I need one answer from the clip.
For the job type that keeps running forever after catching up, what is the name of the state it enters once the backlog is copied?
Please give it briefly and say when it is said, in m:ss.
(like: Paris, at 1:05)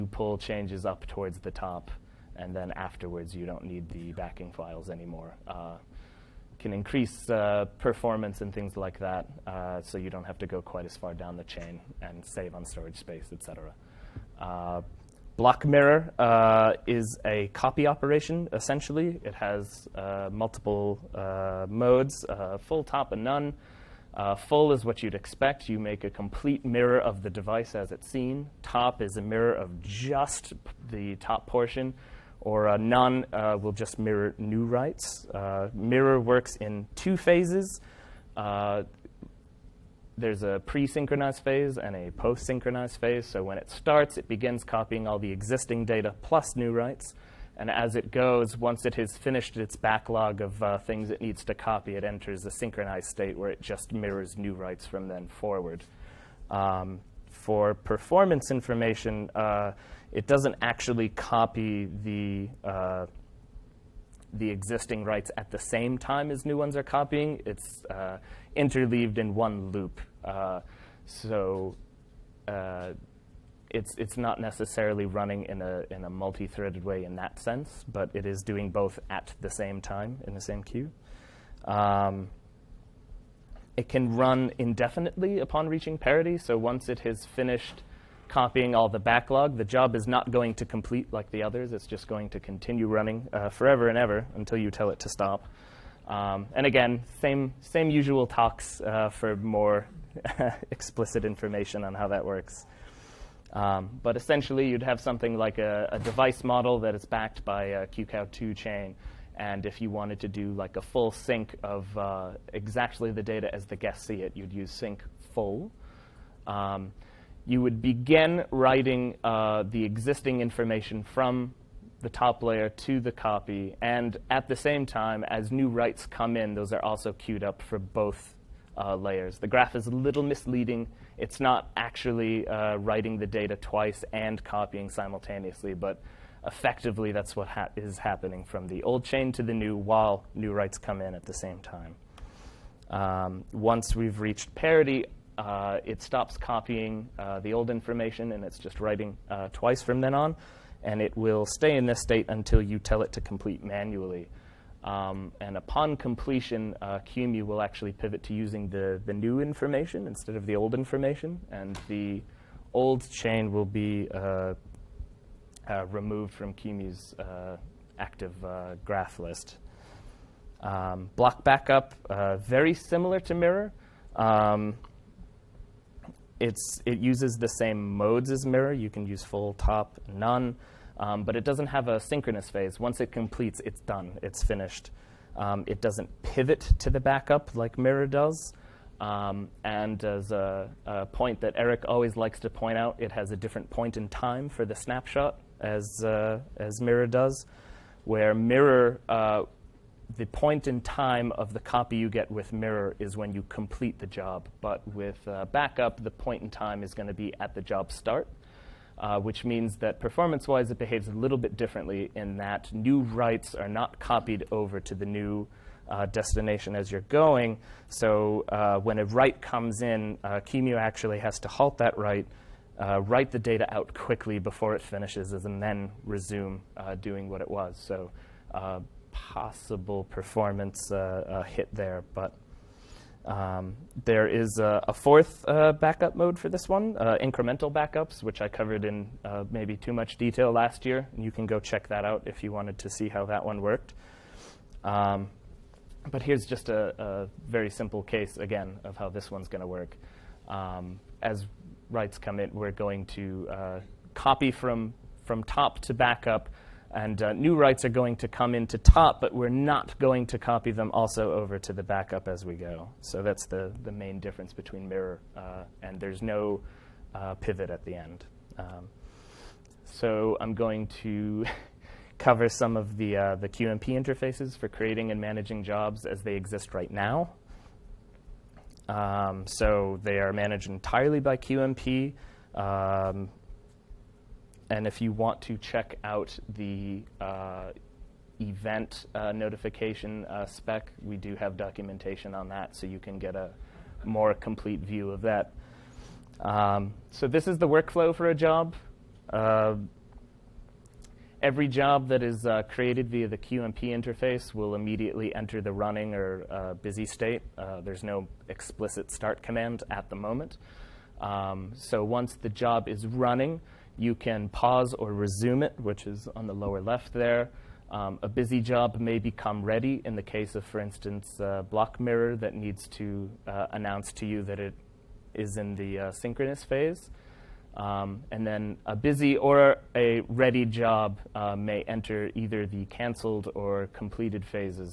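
synchronized state, at 0:52.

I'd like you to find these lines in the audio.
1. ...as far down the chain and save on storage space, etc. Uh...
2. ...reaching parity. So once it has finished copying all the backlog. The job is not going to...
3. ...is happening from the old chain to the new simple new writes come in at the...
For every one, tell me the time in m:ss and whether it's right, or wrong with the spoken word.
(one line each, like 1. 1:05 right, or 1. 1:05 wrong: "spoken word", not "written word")
1. 0:10 right
2. 1:25 right
3. 2:17 wrong: "while", not "simple".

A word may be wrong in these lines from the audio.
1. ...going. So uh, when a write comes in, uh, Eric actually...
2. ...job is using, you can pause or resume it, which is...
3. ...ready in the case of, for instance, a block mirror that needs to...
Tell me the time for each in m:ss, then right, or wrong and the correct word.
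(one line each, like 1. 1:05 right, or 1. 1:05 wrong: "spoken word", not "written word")
1. 3:37 wrong: "QEMU", not "Eric"
2. 5:12 wrong: "running", not "using"
3. 5:19 right.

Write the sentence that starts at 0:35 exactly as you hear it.
Uh, mirror works in two phases.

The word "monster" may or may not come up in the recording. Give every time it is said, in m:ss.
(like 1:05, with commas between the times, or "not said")
not said.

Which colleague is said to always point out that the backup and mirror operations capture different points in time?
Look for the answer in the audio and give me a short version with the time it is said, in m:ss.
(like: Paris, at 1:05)
Eric, at 3:11.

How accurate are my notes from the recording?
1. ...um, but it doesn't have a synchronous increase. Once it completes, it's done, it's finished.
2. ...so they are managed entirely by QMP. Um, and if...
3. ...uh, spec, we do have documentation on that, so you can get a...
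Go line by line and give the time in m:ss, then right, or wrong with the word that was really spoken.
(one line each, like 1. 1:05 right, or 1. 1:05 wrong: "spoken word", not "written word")
1. 3:00 wrong: "phase", not "increase"
2. 4:39 right
3. 4:50 right.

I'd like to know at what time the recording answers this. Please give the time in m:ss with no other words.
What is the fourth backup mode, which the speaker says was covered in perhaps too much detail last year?
3:57.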